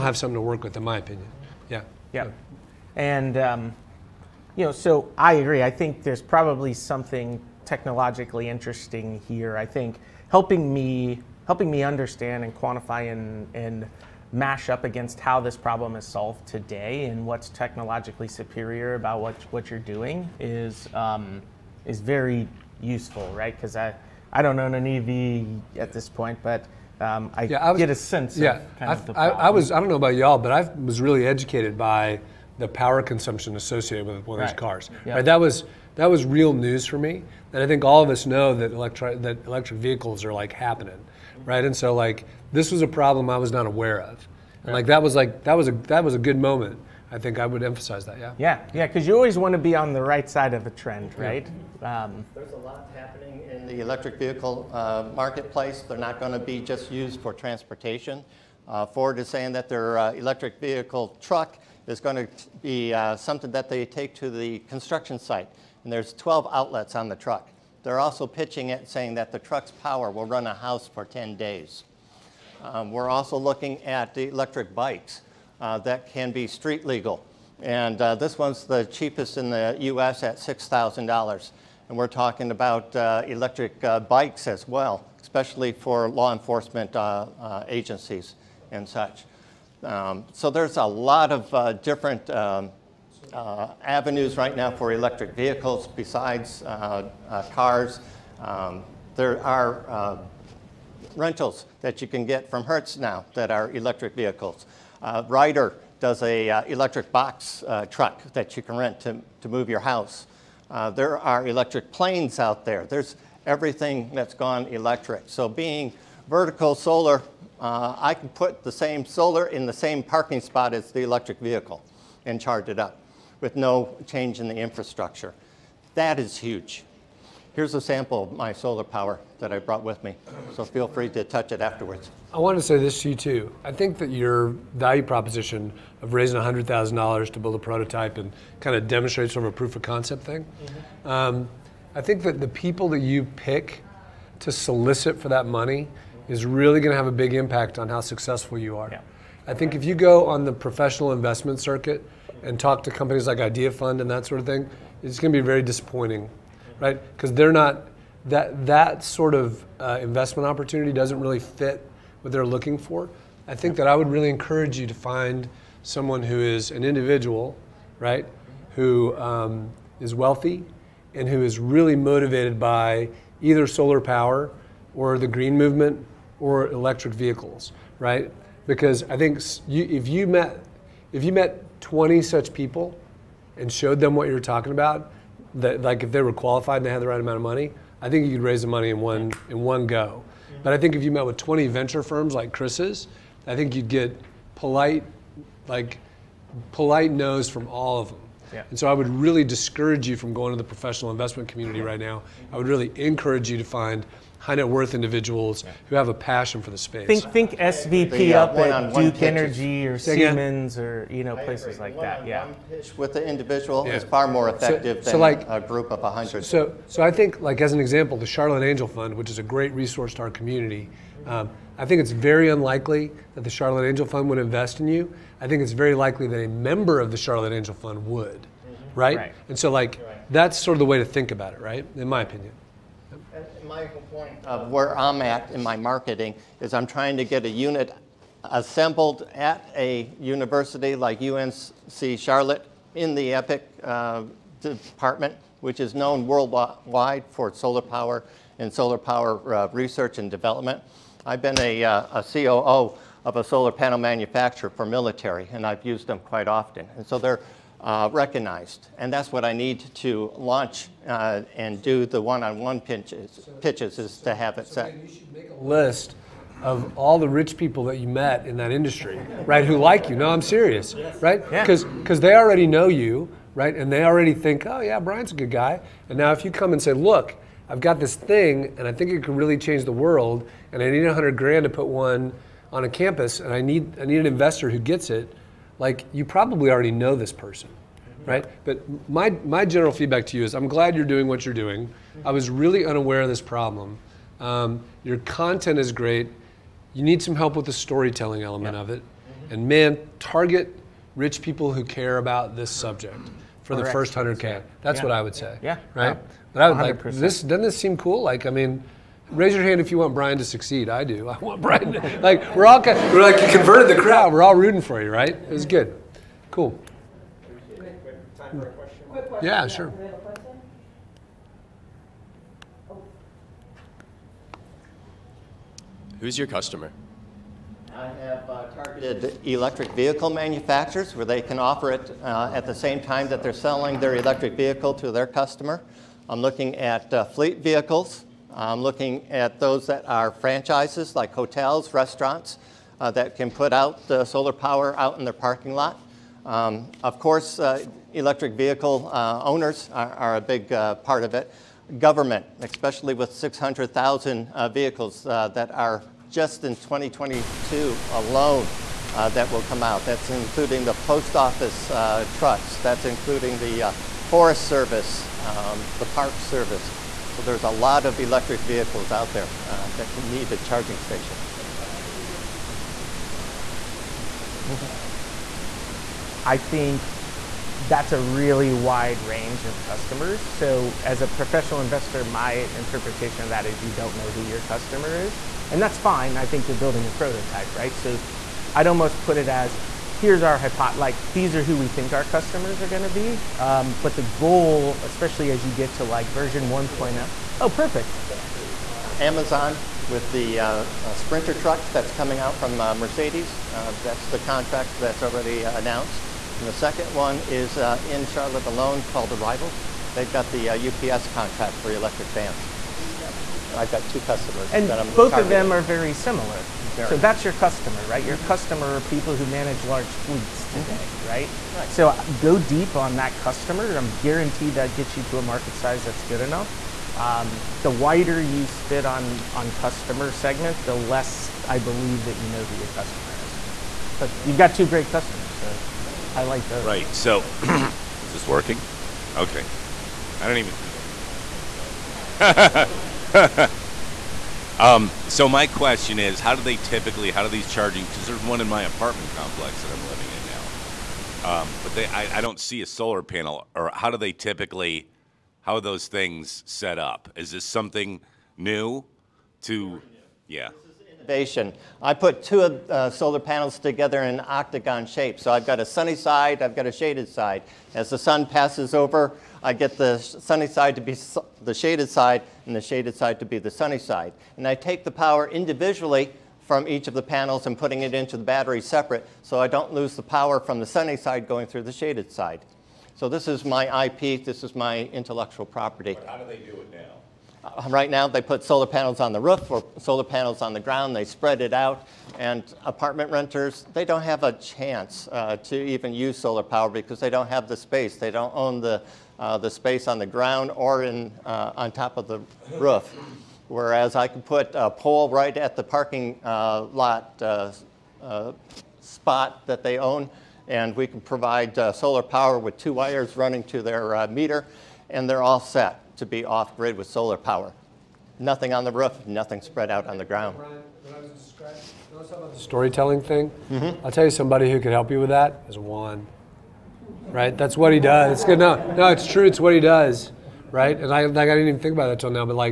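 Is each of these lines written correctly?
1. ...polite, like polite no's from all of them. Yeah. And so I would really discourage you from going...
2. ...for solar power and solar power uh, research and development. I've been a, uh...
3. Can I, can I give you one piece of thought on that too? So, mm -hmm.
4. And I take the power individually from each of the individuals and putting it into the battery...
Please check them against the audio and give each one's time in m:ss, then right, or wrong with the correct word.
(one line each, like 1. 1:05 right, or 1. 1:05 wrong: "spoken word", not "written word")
1. 3:14 right
2. 4:07 right
3. 6:11 right
4. 7:54 wrong: "panels", not "individuals".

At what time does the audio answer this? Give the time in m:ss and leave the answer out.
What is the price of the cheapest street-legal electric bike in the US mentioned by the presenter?
1:20.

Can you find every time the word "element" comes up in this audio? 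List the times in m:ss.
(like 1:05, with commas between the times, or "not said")
4:58.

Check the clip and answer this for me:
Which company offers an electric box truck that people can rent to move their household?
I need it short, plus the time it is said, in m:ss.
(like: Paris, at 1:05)
Ryder, at 1:45.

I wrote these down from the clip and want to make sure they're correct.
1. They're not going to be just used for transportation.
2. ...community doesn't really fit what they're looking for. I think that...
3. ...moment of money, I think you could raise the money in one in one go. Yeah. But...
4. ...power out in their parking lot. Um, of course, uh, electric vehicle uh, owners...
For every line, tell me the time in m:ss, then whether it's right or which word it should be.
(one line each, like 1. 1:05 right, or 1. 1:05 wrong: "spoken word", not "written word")
1. 0:55 right
2. 2:40 wrong: "opportunity", not "community"
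3. 3:07 wrong: "amount", not "moment"
4. 5:44 right.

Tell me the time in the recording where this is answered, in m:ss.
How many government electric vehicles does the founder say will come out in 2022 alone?
5:53.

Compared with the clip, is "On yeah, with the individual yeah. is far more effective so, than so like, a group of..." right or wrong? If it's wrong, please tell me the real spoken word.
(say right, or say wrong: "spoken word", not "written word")
right.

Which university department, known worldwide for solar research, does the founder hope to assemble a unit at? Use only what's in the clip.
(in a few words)
EPIC.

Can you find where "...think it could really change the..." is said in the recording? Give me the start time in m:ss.
4:38.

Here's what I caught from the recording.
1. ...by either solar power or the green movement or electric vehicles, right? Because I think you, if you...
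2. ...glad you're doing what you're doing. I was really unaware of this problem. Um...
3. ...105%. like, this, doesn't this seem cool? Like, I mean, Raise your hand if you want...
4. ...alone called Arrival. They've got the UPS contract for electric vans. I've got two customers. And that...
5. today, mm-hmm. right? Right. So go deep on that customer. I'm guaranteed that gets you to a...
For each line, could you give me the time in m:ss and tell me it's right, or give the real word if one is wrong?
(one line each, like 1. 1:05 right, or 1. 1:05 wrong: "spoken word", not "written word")
1. 2:52 right
2. 4:50 right
3. 5:06 wrong: "100", not "105"
4. 6:48 right
5. 7:00 right.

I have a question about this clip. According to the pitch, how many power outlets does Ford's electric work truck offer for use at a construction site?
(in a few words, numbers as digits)
12.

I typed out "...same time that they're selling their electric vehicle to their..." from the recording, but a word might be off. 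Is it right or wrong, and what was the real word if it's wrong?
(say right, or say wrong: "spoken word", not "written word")
right.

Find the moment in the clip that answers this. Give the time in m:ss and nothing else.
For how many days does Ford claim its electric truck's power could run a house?
1:11.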